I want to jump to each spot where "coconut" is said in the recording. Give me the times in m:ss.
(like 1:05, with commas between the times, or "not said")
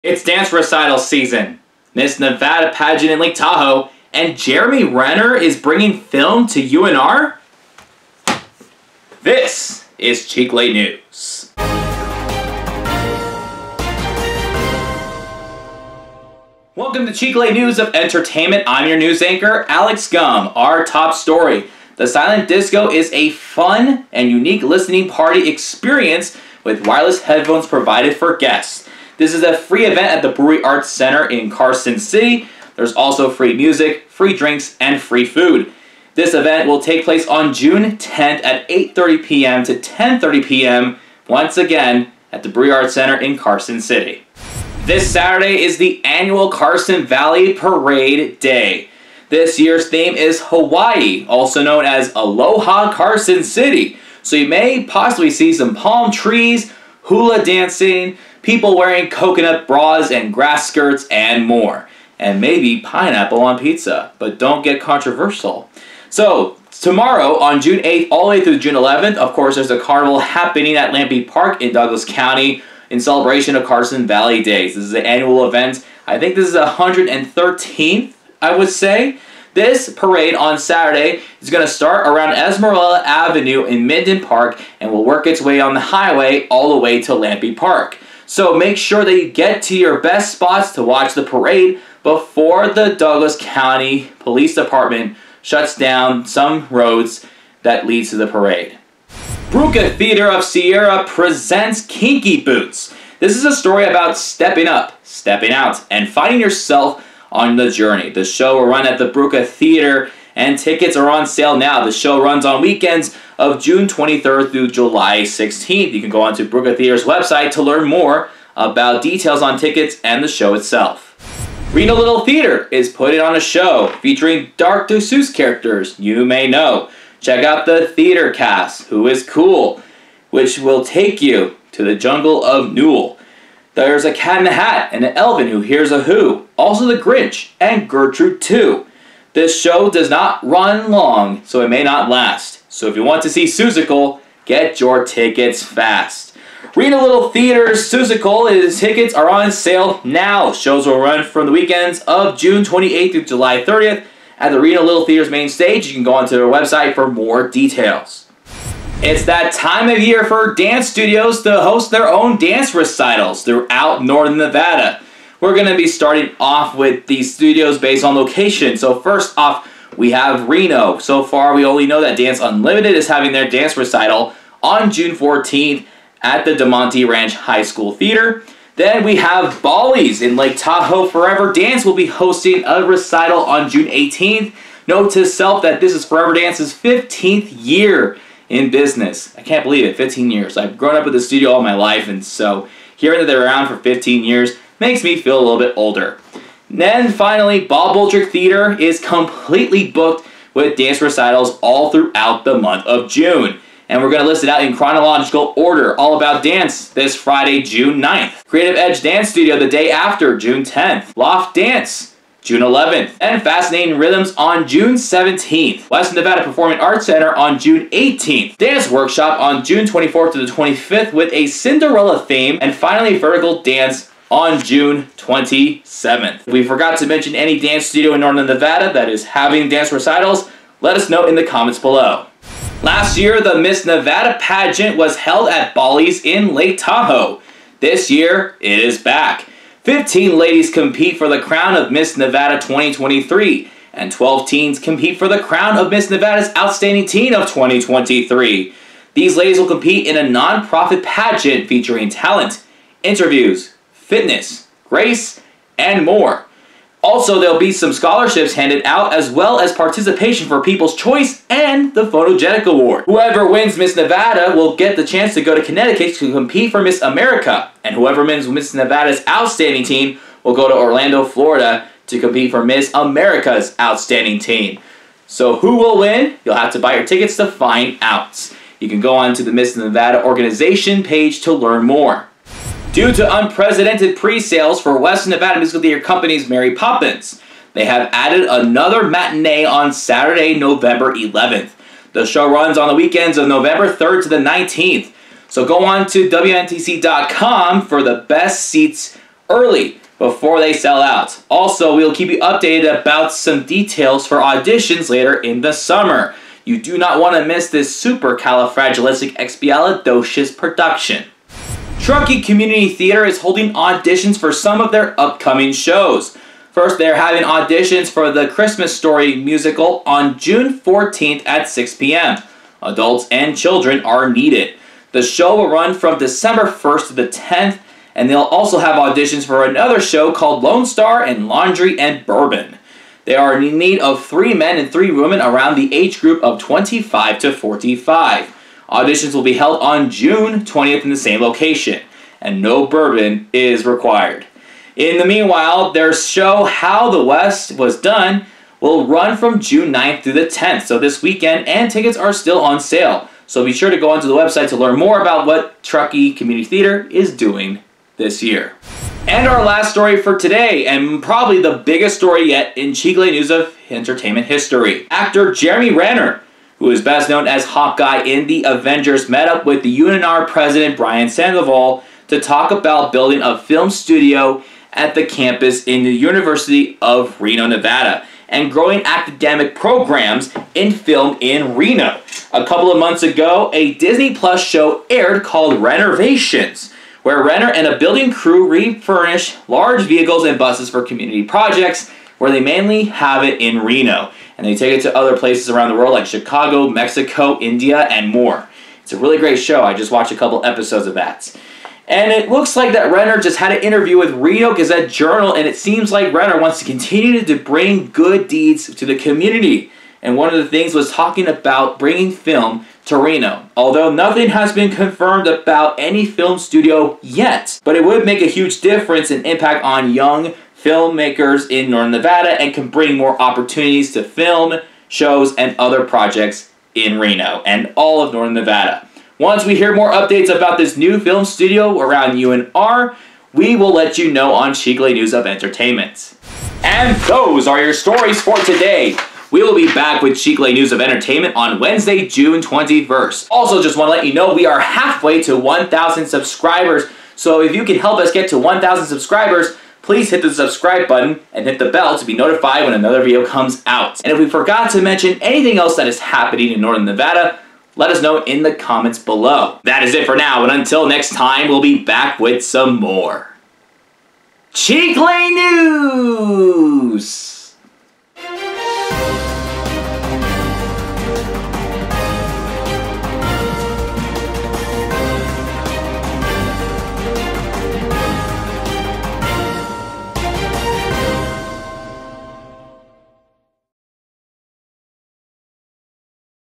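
0:59.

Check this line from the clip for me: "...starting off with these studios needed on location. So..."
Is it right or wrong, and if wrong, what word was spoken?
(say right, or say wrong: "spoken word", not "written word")
wrong: "based", not "needed".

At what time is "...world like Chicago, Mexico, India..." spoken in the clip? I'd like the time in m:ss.
6:35.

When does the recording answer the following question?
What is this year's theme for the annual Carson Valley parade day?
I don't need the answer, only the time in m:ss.
0:50.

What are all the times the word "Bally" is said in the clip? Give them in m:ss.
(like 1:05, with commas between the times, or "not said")
2:59, 3:55.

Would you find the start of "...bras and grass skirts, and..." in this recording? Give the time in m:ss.
0:59.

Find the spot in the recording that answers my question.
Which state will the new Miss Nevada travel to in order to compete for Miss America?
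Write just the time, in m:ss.
4:25.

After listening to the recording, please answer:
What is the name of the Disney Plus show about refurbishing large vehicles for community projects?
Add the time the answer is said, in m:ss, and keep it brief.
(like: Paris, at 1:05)
Rennervations, at 6:25.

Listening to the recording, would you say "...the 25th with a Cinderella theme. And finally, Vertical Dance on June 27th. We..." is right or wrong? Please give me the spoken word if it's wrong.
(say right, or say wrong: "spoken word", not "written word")
right.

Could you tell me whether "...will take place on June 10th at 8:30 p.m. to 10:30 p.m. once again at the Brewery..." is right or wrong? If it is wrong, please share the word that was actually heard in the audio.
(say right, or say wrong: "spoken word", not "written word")
right.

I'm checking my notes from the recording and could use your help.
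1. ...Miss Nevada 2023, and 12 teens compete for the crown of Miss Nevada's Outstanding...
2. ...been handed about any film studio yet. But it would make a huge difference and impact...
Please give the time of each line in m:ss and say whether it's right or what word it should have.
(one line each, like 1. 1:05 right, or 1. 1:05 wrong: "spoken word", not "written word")
1. 4:01 right
2. 6:54 wrong: "confirmed", not "handed".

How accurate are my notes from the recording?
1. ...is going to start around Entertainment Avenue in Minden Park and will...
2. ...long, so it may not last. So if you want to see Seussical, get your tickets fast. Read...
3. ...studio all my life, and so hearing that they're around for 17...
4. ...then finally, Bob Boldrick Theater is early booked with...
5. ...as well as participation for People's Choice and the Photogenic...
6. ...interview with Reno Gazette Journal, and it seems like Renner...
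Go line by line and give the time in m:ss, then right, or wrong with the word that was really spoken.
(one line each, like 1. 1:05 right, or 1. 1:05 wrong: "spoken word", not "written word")
1. 1:21 wrong: "Esmeralda", not "Entertainment"
2. 2:20 right
3. 3:11 wrong: "15", not "17"
4. 3:16 wrong: "completely", not "early"
5. 4:19 right
6. 6:43 right.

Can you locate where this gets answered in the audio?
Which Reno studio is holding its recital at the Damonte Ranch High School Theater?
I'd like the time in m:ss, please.
2:52.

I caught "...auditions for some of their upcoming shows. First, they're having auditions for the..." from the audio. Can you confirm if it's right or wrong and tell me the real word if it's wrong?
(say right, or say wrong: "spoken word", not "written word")
right.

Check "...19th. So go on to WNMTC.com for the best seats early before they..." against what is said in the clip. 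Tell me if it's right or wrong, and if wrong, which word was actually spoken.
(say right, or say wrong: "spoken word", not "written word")
right.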